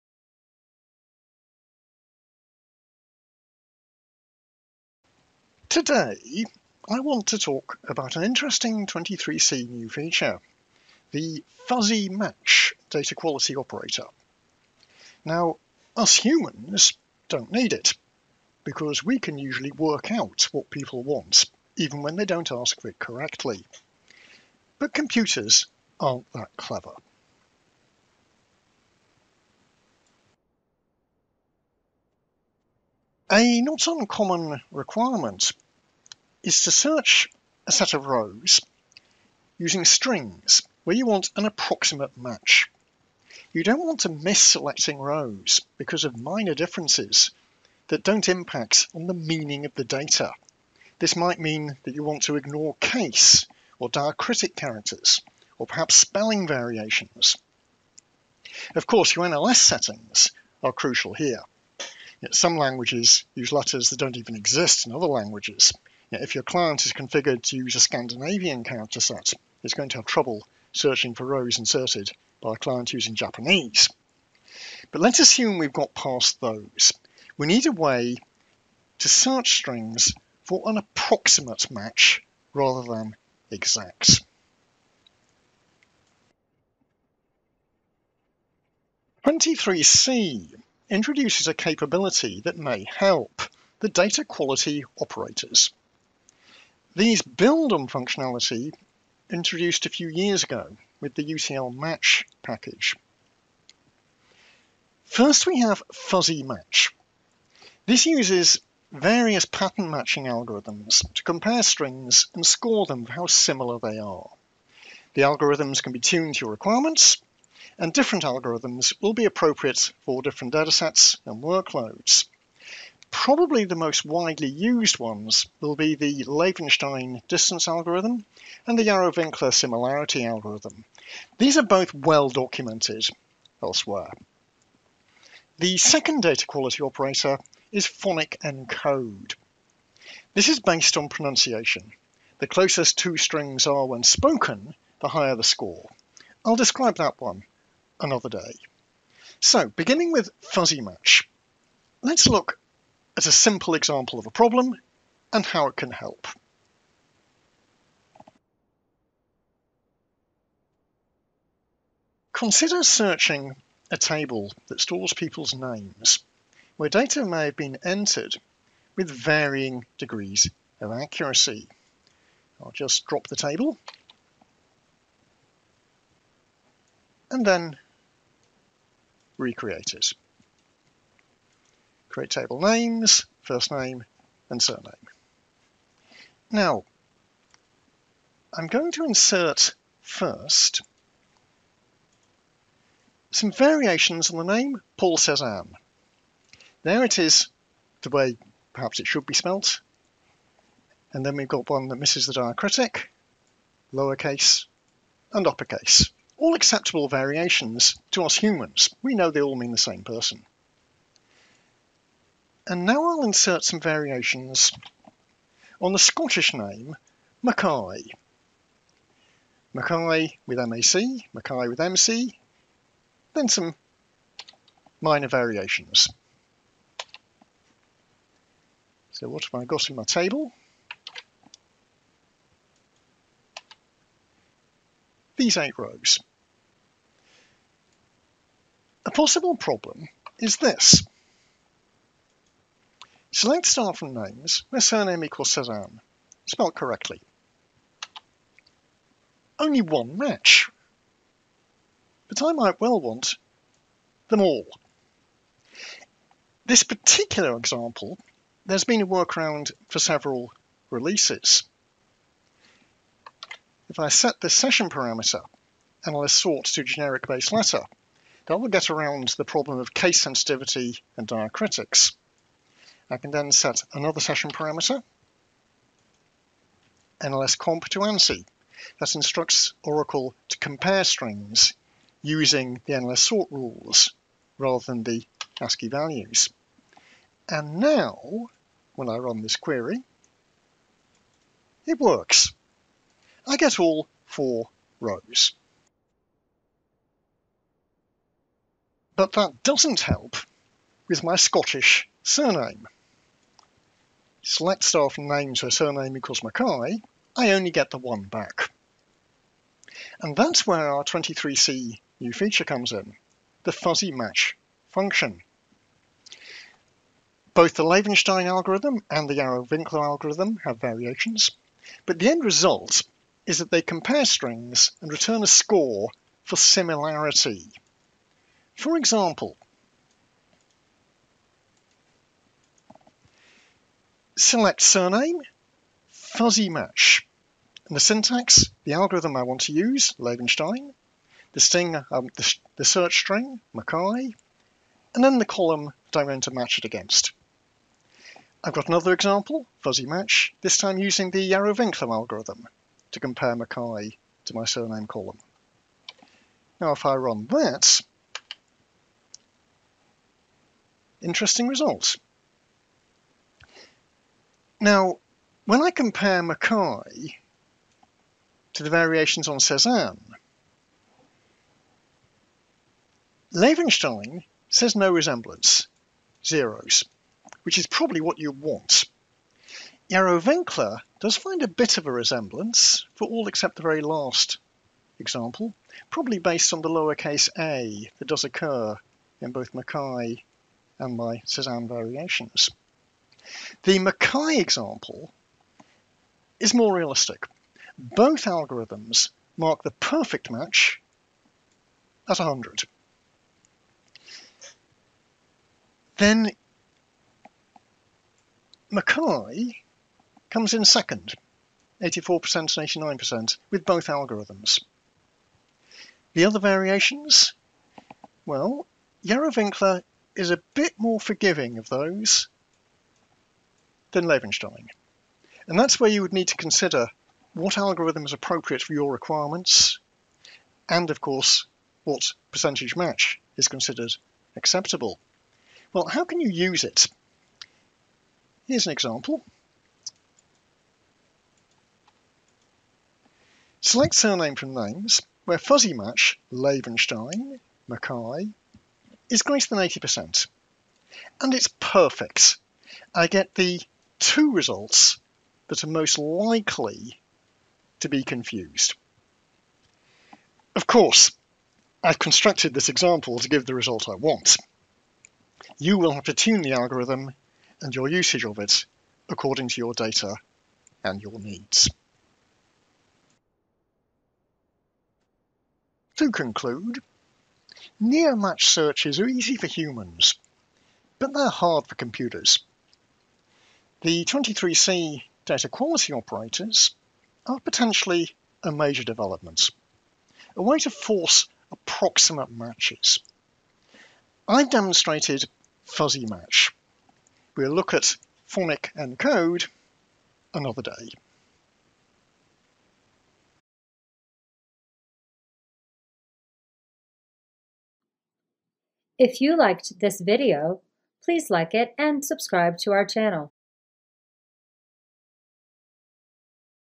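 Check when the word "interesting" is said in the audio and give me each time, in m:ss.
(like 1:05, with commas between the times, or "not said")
0:08, 6:01.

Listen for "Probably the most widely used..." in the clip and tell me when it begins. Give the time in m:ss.
2:03.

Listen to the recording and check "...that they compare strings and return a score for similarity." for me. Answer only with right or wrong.
right.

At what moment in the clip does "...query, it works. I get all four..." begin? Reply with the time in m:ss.
4:49.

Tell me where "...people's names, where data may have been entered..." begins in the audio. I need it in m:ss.
2:45.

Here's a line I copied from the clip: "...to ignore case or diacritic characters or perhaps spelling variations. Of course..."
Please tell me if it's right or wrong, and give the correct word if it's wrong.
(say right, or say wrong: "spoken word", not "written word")
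right.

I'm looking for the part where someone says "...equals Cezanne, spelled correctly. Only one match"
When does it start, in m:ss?
4:05.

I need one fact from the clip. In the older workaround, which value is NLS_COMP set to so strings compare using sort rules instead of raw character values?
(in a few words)
ANSI.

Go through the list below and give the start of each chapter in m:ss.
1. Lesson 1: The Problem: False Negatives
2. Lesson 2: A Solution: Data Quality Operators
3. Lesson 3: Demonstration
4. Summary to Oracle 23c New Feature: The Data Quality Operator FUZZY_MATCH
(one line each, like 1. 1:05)
1. 0:30
2. 1:26
3. 2:38
4. 7:54.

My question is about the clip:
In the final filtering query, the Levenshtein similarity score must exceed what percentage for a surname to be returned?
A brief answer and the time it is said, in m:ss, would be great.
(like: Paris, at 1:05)
80%, at 7:29.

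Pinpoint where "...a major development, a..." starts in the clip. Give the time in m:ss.
8:08.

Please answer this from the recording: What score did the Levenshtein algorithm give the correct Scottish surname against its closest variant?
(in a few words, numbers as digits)
84%.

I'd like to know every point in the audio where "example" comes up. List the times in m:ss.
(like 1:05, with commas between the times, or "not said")
2:33, 4:17, 5:28, 5:49, 6:25, 6:34, 7:18, 7:42.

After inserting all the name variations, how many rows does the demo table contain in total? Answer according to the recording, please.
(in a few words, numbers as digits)
8.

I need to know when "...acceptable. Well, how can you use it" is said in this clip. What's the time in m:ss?
7:14.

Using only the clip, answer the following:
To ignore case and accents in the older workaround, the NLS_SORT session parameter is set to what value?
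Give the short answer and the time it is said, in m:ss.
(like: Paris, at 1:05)
generic base letter, at 4:26.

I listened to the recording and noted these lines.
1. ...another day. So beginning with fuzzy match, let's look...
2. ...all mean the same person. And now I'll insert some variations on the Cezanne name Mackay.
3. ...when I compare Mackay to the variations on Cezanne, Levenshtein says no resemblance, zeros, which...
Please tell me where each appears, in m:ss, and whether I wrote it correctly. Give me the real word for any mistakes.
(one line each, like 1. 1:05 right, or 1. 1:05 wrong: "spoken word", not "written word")
1. 2:27 right
2. 3:29 wrong: "Scottish", not "Cezanne"
3. 6:05 right.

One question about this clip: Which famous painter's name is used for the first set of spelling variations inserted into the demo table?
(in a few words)
Paul Cezanne.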